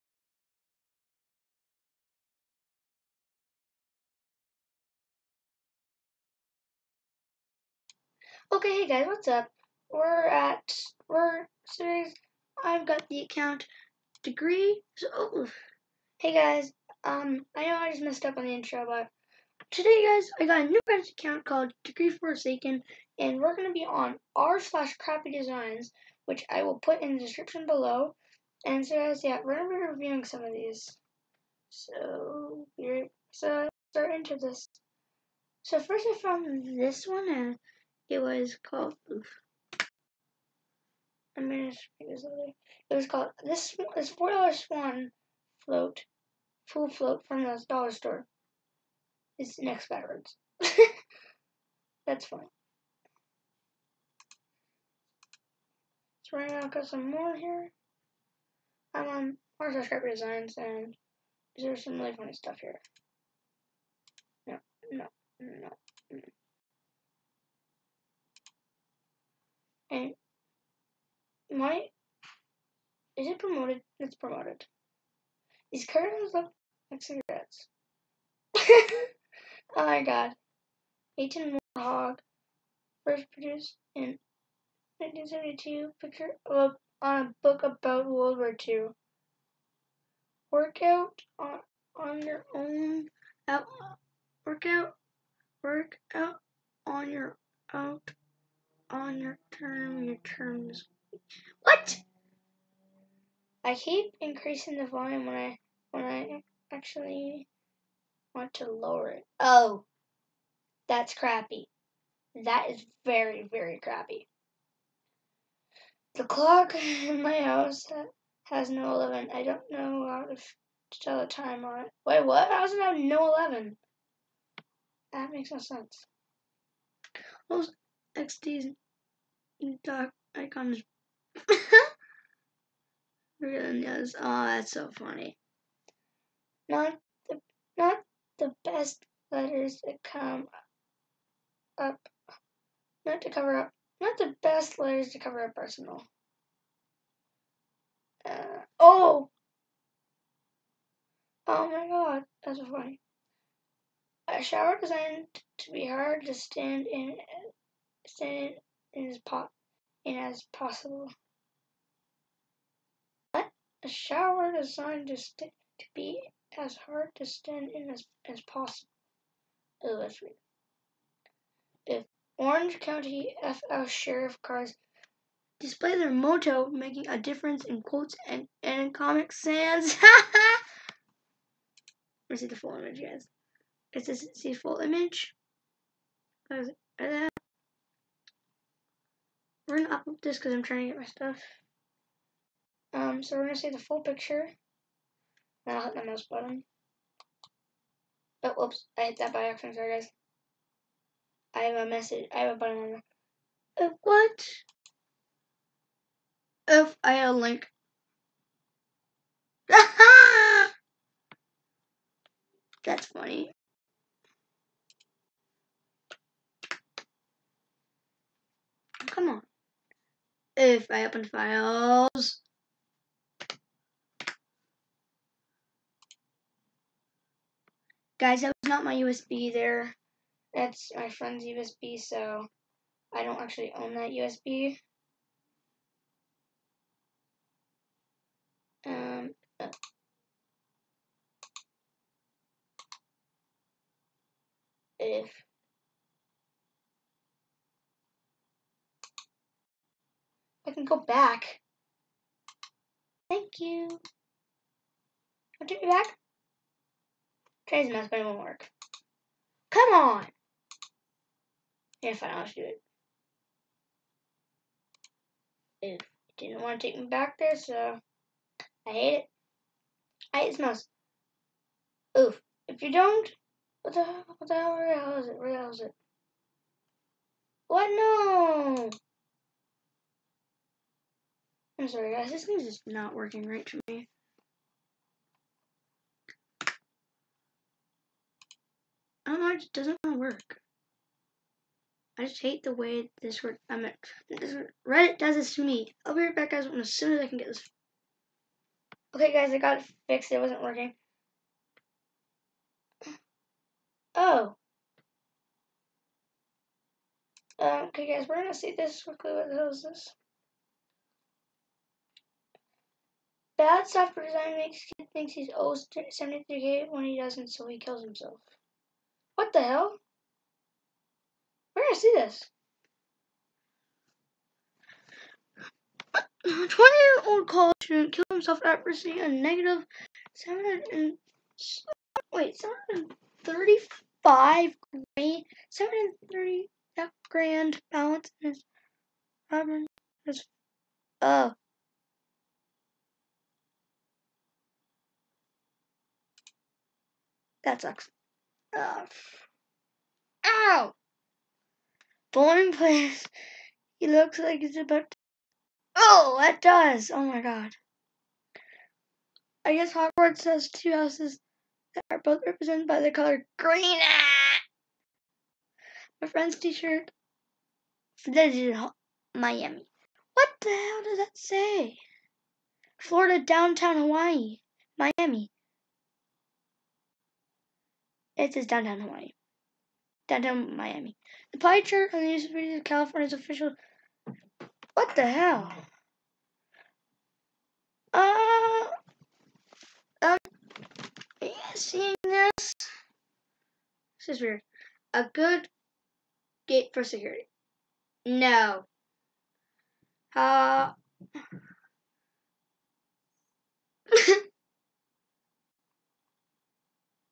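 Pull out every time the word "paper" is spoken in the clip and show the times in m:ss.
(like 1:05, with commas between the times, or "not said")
not said.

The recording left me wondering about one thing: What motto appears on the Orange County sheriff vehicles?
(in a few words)
Making a difference.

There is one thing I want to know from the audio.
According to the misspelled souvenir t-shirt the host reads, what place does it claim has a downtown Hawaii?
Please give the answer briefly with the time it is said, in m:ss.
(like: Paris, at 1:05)
Florida, at 6:12.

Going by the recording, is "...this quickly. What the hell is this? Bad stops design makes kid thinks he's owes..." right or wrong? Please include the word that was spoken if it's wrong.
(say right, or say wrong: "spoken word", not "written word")
right.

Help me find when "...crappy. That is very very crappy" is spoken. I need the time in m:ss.
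1:51.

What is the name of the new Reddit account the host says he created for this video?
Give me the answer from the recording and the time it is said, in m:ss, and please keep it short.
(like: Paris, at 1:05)
Degree Forsaken, at 0:21.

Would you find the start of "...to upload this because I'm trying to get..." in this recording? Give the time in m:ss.
3:09.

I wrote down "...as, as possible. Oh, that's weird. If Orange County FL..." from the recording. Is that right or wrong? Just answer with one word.
right.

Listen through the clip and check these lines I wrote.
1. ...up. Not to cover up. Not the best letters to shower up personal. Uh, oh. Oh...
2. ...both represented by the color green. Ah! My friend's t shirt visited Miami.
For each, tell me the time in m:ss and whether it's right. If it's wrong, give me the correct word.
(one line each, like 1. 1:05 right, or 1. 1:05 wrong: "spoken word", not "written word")
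1. 2:21 wrong: "cover", not "shower"
2. 6:02 right.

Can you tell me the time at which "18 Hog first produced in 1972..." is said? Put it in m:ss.
1:21.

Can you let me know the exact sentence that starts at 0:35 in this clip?
So first I found this one, and it was called.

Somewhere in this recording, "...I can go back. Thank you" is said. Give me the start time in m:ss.
4:10.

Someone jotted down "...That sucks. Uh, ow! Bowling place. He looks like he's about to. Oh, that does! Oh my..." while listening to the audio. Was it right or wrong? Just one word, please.
right.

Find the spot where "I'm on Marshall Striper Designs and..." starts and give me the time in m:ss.
0:58.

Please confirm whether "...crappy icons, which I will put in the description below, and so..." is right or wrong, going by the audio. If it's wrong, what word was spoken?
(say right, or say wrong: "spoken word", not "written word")
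wrong: "designs", not "icons".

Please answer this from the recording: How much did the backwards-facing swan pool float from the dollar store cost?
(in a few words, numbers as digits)
$4.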